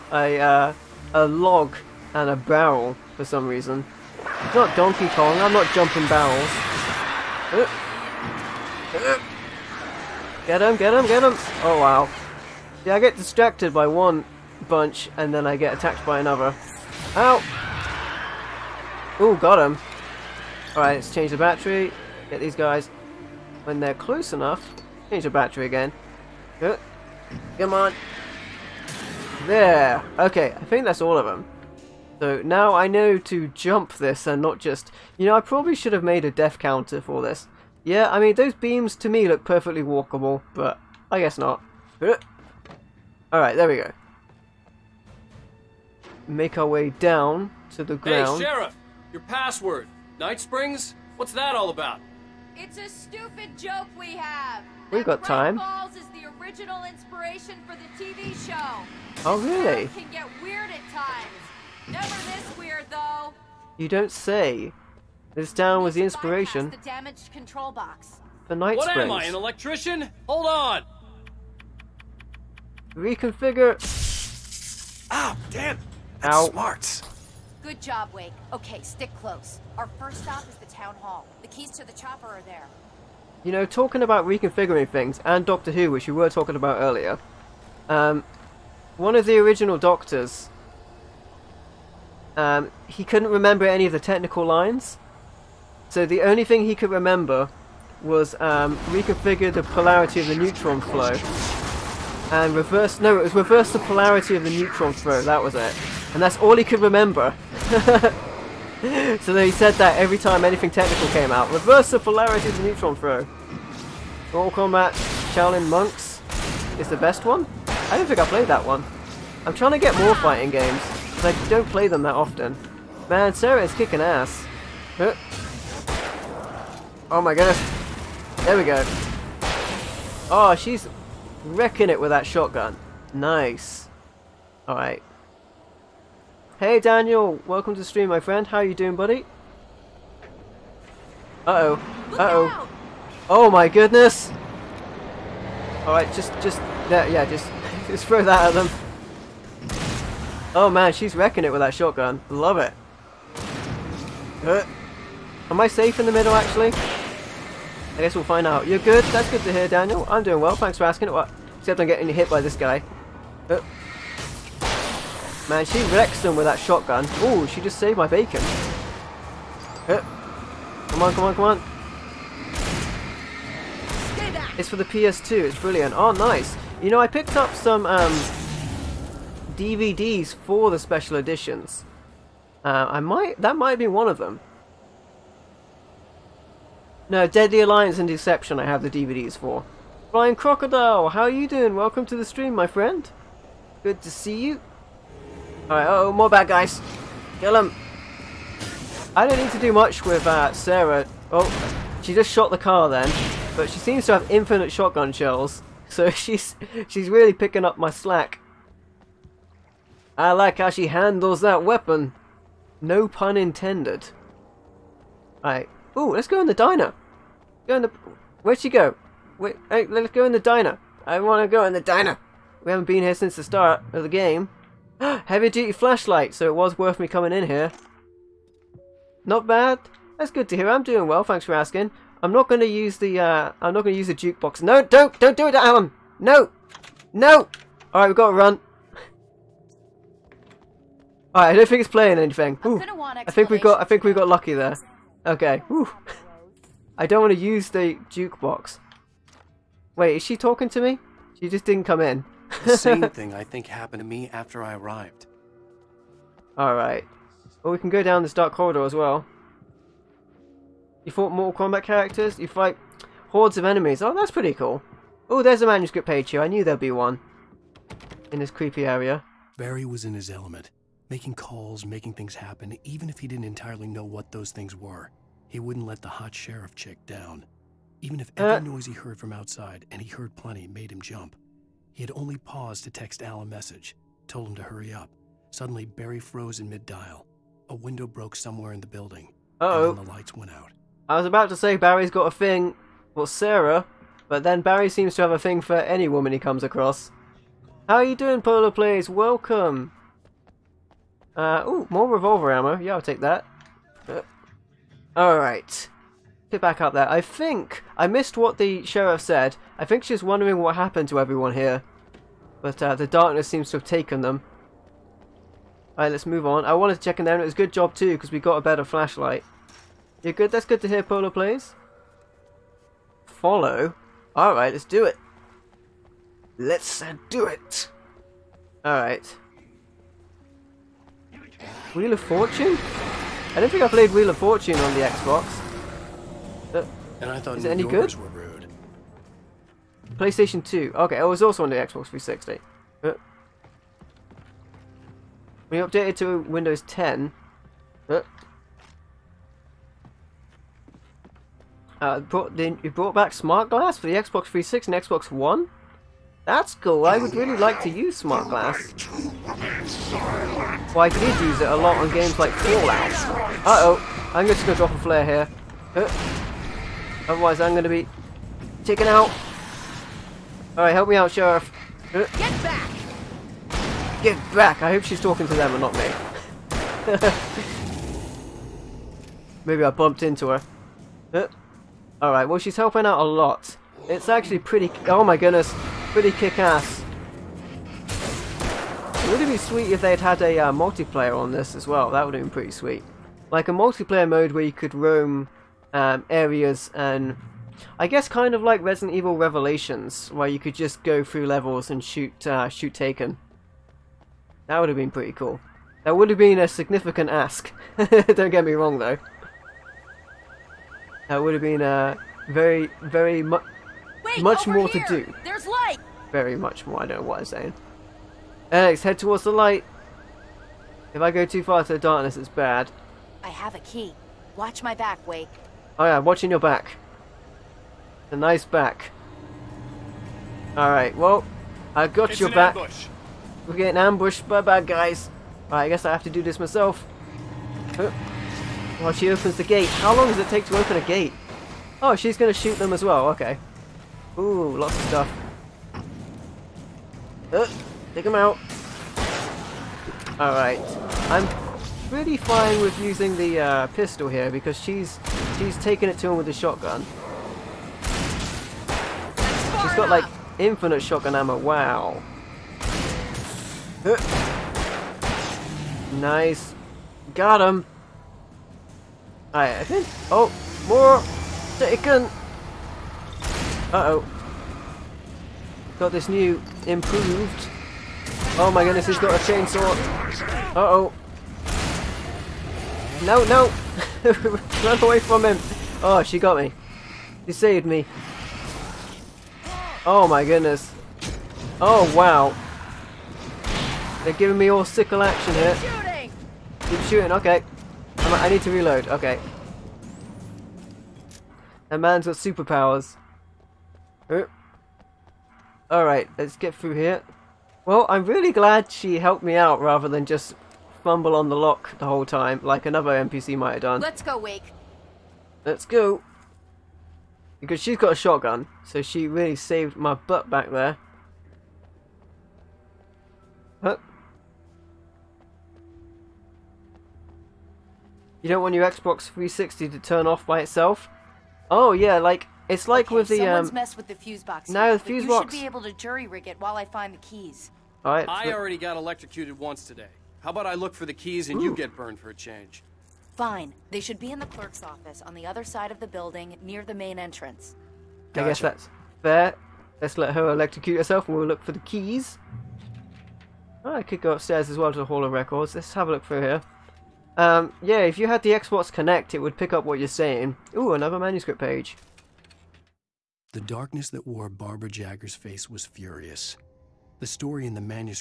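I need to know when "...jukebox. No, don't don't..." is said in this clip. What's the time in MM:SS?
03:54.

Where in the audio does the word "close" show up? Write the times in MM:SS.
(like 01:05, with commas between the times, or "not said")
00:23, 01:19.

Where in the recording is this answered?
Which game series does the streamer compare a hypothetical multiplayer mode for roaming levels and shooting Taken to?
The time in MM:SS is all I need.
06:38.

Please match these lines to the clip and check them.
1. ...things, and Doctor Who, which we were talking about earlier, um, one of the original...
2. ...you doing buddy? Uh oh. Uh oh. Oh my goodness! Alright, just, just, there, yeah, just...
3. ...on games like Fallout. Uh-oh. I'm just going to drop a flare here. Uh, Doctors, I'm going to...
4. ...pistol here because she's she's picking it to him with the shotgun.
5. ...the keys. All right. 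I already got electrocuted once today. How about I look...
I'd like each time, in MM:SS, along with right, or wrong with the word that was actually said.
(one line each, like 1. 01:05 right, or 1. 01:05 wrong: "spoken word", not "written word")
1. 01:24 right
2. 02:18 right
3. 06:01 wrong: "Otherwise", not "Doctors"
4. 07:33 wrong: "taking", not "picking"
5. 08:57 right.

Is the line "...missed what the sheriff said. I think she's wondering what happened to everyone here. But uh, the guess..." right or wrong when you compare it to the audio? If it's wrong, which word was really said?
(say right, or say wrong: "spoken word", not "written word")
wrong: "darkness", not "guess".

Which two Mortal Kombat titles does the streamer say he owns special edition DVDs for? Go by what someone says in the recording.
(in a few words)
Deadly Alliance and Deception.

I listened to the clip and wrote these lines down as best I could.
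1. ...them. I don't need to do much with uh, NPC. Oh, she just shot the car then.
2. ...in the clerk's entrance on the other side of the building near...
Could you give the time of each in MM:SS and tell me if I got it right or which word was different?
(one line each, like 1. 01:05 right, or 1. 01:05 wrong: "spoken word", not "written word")
1. 03:17 wrong: "Sarah", not "NPC"
2. 09:04 wrong: "office", not "entrance".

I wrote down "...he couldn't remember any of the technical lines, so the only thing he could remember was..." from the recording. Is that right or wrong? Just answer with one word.
right.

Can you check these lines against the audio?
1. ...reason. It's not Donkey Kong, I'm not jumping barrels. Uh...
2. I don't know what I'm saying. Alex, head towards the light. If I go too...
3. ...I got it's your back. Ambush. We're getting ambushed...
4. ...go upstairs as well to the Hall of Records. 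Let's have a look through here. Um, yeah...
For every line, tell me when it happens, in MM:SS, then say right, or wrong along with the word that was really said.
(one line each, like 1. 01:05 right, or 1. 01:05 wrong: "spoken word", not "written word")
1. 00:03 right
2. 06:57 right
3. 07:11 right
4. 09:14 right.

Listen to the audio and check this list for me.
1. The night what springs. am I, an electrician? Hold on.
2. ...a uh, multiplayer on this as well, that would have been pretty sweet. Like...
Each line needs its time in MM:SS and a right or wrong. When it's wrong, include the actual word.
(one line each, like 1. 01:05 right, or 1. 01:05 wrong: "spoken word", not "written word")
1. 01:08 right
2. 06:30 right.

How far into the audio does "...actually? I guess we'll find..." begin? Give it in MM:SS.
02:36.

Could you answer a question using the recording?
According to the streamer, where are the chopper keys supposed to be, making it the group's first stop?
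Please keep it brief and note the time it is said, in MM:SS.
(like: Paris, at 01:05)
the town hall, at 01:20.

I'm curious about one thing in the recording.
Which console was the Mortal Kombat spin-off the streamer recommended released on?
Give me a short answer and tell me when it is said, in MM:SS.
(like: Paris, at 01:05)
PS2, at 02:54.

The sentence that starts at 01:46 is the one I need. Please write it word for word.
And that's all he could remember.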